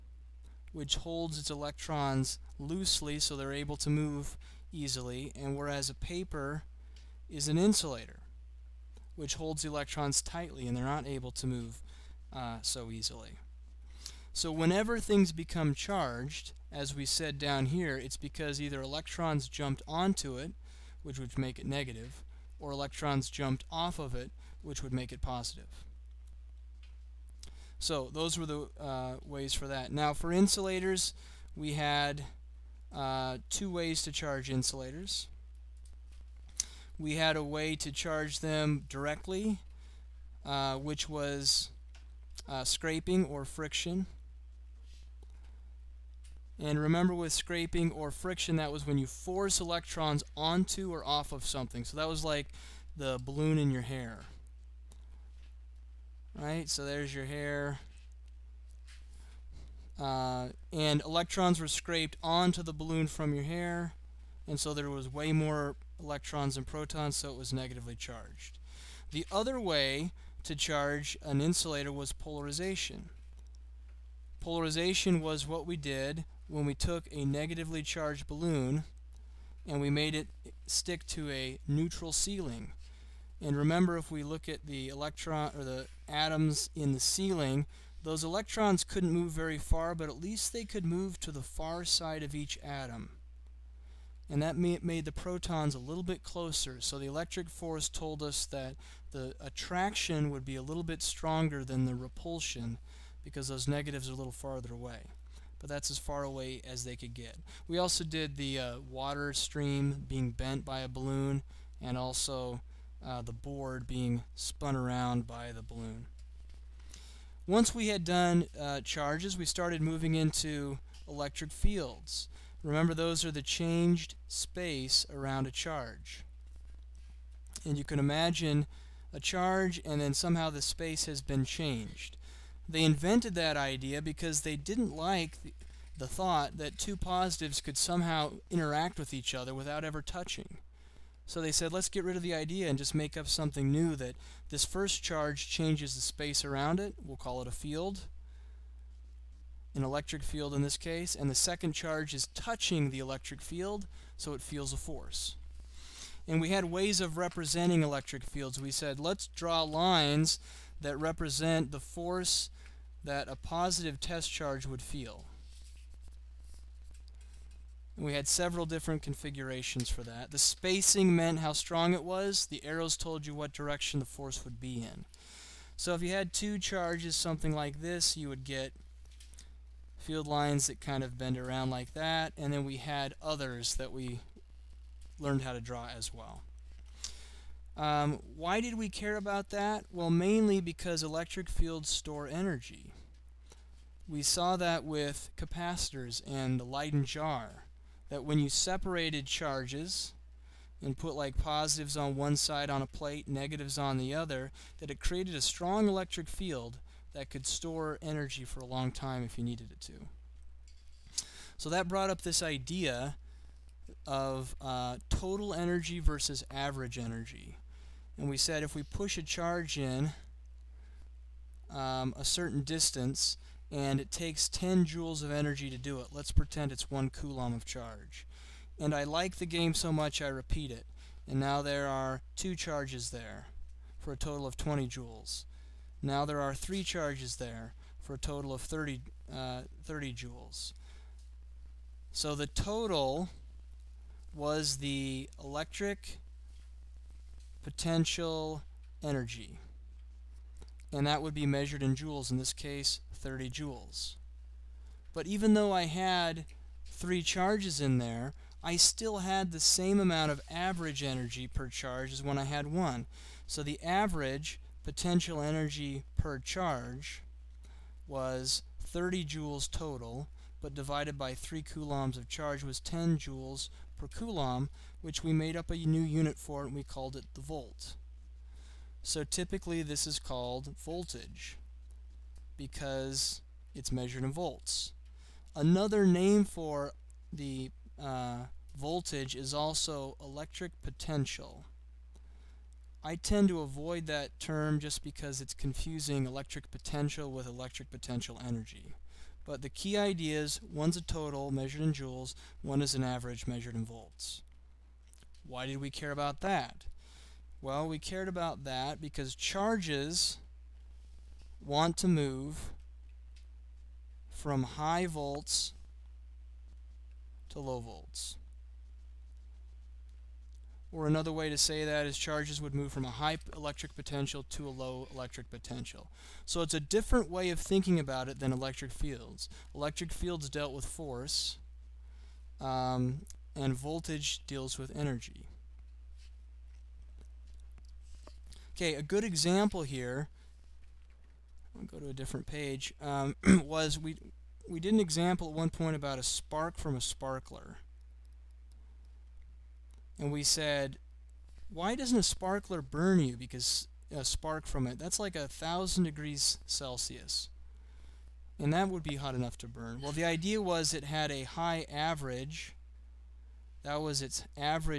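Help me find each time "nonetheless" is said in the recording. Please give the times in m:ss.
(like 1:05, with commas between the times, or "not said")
not said.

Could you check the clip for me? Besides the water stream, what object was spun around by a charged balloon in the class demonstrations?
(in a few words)
the board.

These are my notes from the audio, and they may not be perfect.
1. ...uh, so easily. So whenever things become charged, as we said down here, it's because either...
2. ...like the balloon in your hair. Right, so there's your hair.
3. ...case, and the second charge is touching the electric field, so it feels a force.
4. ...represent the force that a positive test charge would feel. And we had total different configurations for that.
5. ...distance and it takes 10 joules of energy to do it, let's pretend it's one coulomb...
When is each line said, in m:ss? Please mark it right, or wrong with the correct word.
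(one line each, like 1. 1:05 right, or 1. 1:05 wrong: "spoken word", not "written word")
1. 0:12 right
2. 0:52 right
3. 2:30 right
4. 2:40 wrong: "several", not "total"
5. 3:42 right.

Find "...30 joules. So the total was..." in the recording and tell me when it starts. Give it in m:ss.
3:59.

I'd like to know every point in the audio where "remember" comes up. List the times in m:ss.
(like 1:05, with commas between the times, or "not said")
0:46, 1:23, 2:02.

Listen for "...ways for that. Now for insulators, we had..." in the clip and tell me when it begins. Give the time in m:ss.
0:29.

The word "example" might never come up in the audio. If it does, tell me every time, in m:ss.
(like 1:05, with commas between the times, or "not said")
5:39, 5:45.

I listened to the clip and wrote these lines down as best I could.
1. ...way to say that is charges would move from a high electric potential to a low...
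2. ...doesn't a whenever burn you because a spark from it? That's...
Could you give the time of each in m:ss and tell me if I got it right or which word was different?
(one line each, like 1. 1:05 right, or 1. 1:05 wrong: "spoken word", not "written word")
1. 5:21 right
2. 5:51 wrong: "sparkler", not "whenever".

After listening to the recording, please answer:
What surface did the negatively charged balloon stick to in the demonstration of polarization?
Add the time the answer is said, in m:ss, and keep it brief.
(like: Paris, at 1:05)
neutral ceiling, at 1:21.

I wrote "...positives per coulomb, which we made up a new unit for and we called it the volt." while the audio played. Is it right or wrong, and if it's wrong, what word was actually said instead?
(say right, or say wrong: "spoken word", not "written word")
wrong: "joules", not "positives".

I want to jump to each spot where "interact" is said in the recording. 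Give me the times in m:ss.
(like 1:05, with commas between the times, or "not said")
2:18.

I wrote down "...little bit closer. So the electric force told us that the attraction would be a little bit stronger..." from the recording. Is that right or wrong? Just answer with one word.
right.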